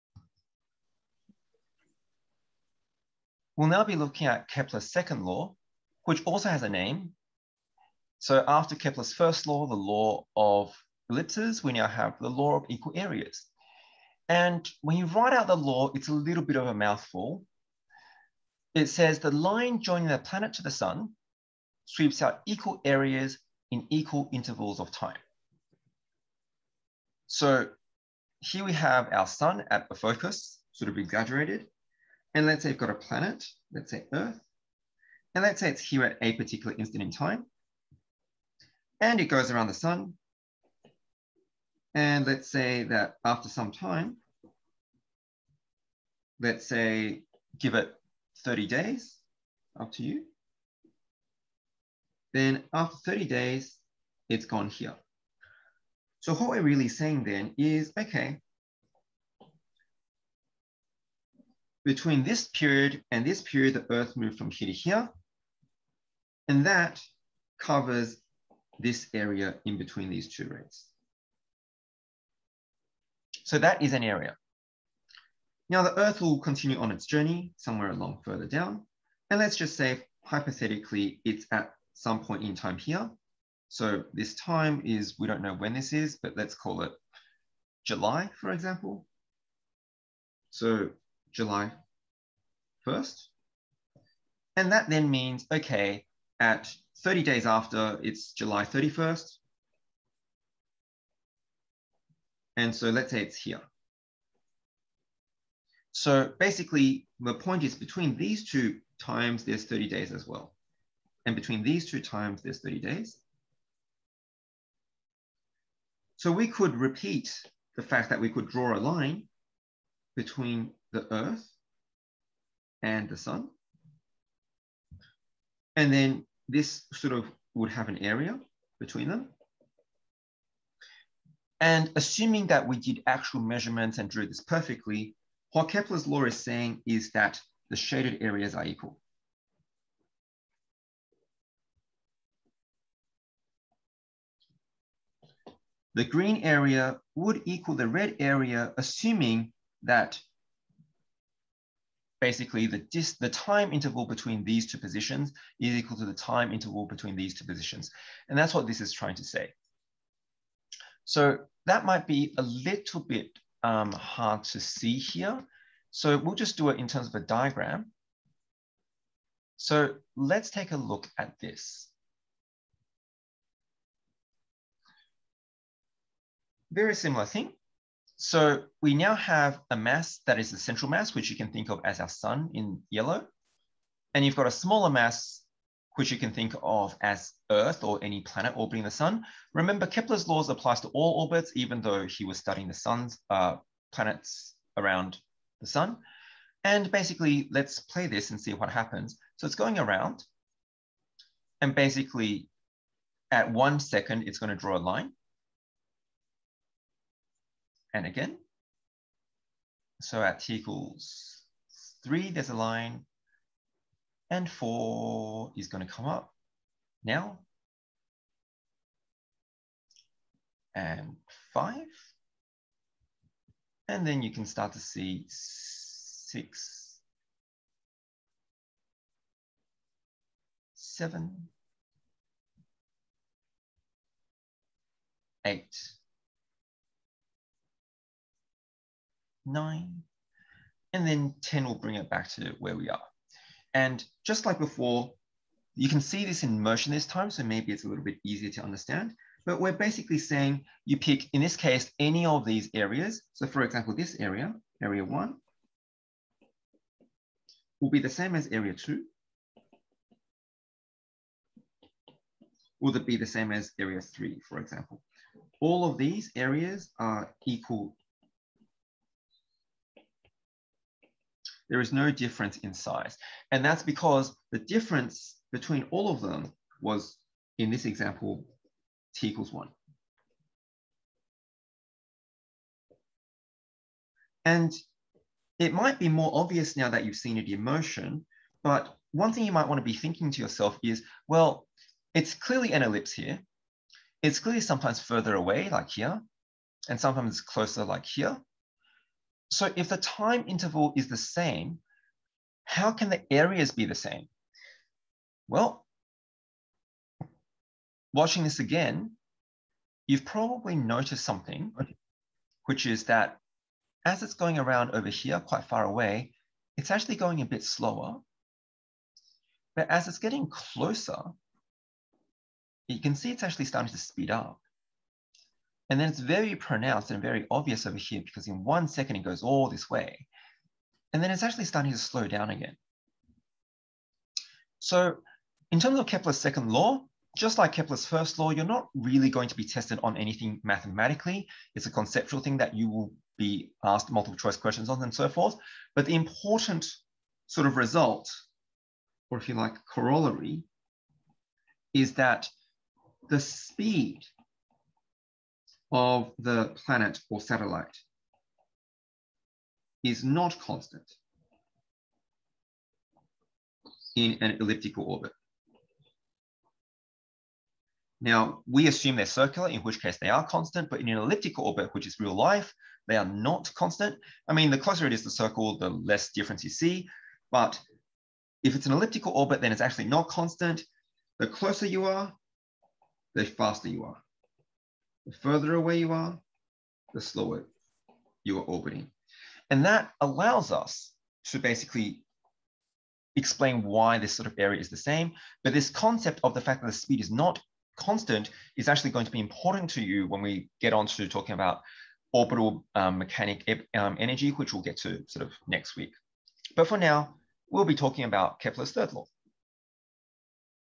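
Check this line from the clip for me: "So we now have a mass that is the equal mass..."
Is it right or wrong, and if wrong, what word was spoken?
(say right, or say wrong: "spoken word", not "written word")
wrong: "central", not "equal".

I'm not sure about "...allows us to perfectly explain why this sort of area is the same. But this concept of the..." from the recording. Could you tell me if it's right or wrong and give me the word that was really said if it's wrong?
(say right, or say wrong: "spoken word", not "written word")
wrong: "basically", not "perfectly".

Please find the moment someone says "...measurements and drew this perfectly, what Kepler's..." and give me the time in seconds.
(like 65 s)
133 s.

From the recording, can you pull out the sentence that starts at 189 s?
Remember, Kepler's laws applies to all orbits, even though he was studying the sun's uh, planets around the sun.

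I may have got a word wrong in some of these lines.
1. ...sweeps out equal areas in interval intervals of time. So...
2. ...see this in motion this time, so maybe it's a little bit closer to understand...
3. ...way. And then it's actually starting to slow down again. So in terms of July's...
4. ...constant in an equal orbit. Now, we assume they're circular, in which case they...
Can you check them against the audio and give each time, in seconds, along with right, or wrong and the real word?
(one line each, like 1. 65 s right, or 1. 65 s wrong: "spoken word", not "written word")
1. 21 s wrong: "equal", not "interval"
2. 246 s wrong: "easier", not "closer"
3. 329 s wrong: "Kepler", not "July"
4. 360 s wrong: "elliptical", not "equal".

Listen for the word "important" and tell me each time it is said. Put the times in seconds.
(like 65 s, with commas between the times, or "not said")
346 s, 399 s.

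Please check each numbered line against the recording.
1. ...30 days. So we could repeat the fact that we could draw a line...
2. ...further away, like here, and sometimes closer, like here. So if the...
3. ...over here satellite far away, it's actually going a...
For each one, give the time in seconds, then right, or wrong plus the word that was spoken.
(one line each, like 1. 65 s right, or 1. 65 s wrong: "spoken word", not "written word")
1. 112 s right
2. 294 s right
3. 314 s wrong: "quite", not "satellite".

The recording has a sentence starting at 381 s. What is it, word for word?
The closer you are, the faster you are.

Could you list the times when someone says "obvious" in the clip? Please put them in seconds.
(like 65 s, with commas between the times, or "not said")
286 s, 327 s.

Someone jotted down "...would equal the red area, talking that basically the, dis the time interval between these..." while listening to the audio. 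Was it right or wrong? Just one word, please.
wrong.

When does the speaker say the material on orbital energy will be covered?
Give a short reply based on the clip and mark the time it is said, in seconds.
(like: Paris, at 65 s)
Next week, at 405 s.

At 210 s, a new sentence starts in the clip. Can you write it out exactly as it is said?
So at t equals three, there's a line and four is gonna come up now.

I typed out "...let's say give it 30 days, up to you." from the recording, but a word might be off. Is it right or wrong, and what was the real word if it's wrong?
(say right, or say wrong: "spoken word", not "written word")
right.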